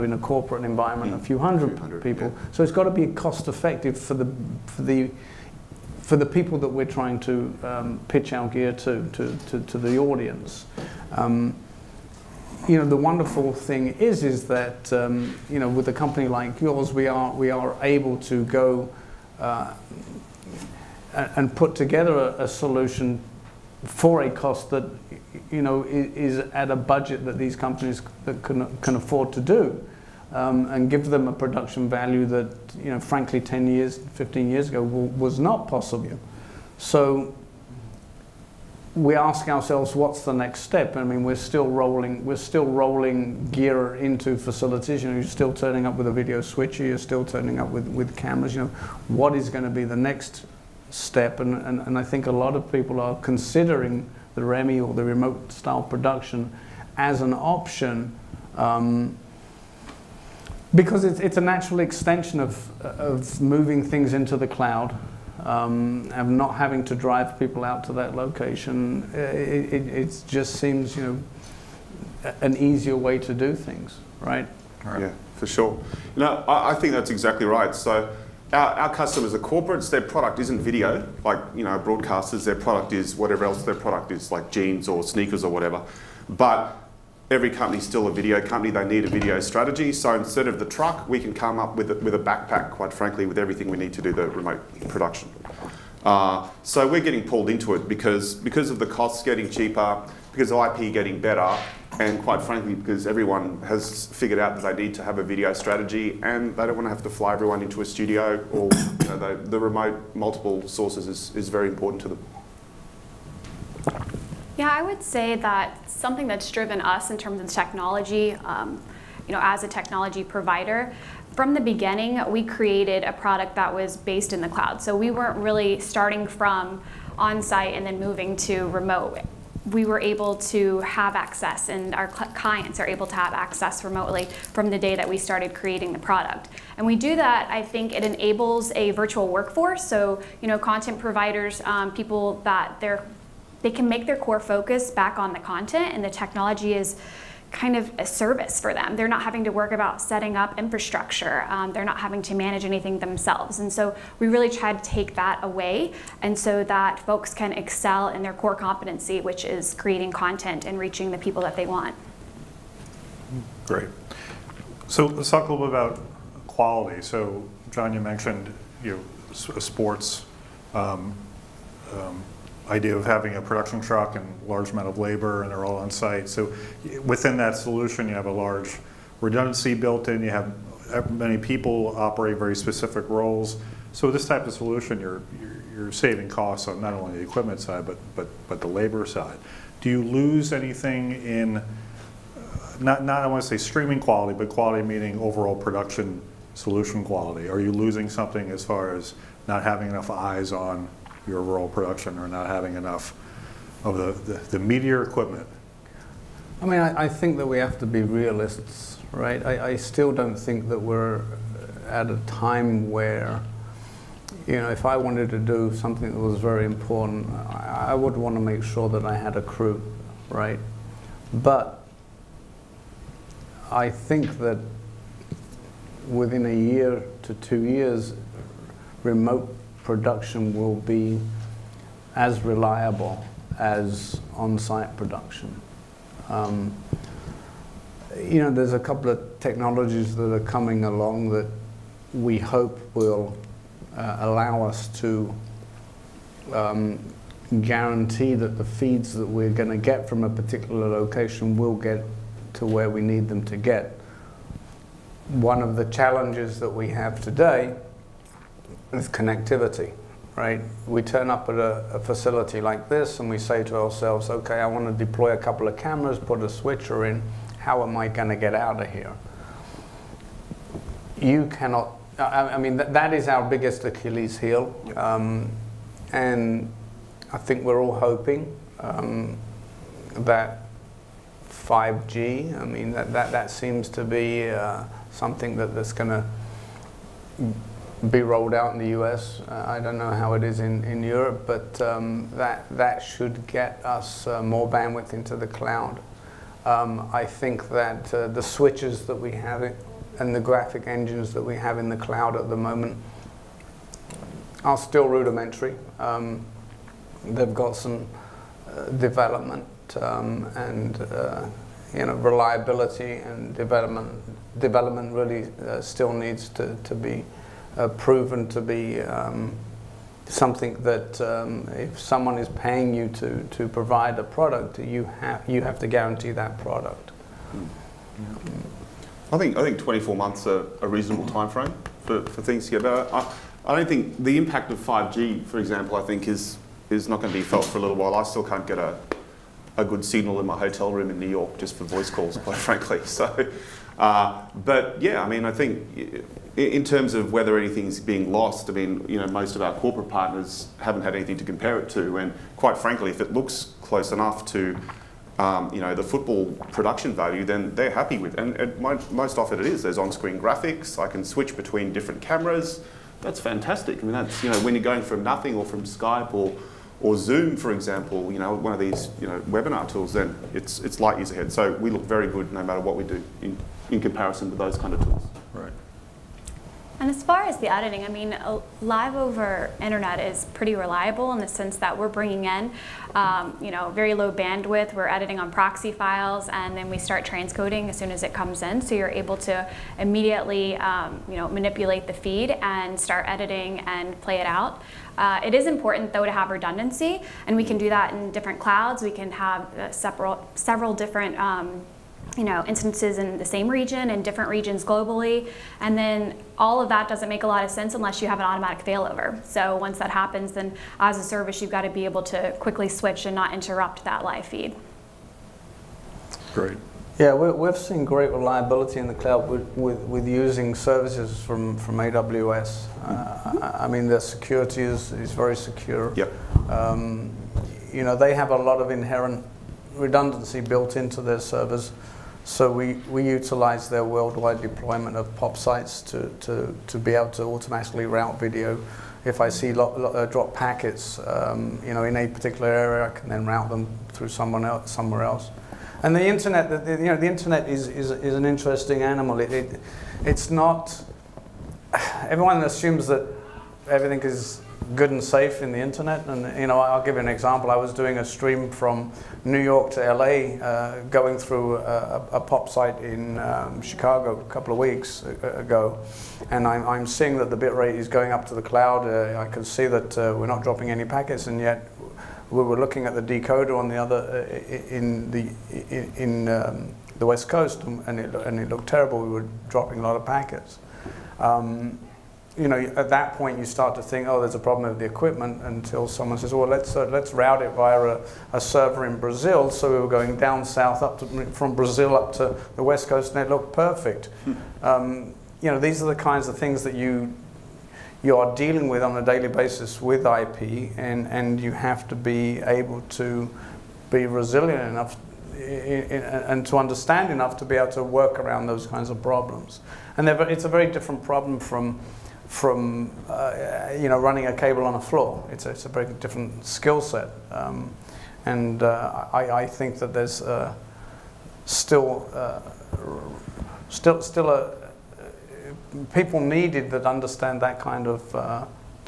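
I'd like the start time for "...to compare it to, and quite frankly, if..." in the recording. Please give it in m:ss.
5:51.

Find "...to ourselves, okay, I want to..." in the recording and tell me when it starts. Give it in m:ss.
4:23.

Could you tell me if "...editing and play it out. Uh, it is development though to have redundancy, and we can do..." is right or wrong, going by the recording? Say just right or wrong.
wrong.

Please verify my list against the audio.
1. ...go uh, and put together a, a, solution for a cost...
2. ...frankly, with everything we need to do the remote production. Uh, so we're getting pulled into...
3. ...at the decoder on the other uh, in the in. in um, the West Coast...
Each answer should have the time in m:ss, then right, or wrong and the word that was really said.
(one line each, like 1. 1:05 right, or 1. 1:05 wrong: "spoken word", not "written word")
1. 0:18 right
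2. 1:32 right
3. 7:53 right.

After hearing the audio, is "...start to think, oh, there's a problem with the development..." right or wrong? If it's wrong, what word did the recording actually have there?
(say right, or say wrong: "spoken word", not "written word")
wrong: "equipment", not "development".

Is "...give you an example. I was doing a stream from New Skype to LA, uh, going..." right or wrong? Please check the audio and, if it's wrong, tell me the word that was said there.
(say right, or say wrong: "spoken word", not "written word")
wrong: "York", not "Skype".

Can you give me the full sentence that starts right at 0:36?
So we ask ourselves, what's the next step?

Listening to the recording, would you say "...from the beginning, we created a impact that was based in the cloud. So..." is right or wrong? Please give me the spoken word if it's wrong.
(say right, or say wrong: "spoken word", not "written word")
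wrong: "product", not "impact".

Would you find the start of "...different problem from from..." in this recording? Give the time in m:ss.
8:30.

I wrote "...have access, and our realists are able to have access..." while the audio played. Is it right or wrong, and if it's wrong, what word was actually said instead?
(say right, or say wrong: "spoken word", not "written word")
wrong: "clients", not "realists".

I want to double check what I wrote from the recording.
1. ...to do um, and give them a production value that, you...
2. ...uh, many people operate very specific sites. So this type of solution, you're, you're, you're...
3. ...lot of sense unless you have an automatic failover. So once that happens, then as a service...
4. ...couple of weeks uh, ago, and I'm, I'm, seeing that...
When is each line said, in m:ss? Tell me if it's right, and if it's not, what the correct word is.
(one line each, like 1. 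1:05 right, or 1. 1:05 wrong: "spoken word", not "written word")
1. 0:29 right
2. 3:00 wrong: "roles", not "sites"
3. 6:47 right
4. 7:44 right.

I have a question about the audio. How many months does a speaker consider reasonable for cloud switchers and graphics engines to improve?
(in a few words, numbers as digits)
24.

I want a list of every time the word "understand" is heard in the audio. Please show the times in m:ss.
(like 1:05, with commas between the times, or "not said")
8:26, 8:47.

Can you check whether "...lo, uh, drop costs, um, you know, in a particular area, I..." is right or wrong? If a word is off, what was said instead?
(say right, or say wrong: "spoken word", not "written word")
wrong: "packets", not "costs".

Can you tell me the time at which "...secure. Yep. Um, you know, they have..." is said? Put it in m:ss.
7:05.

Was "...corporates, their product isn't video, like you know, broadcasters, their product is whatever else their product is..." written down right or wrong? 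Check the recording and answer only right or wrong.
right.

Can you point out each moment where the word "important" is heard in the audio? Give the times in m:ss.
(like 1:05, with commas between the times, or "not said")
1:51, 3:36, 6:35.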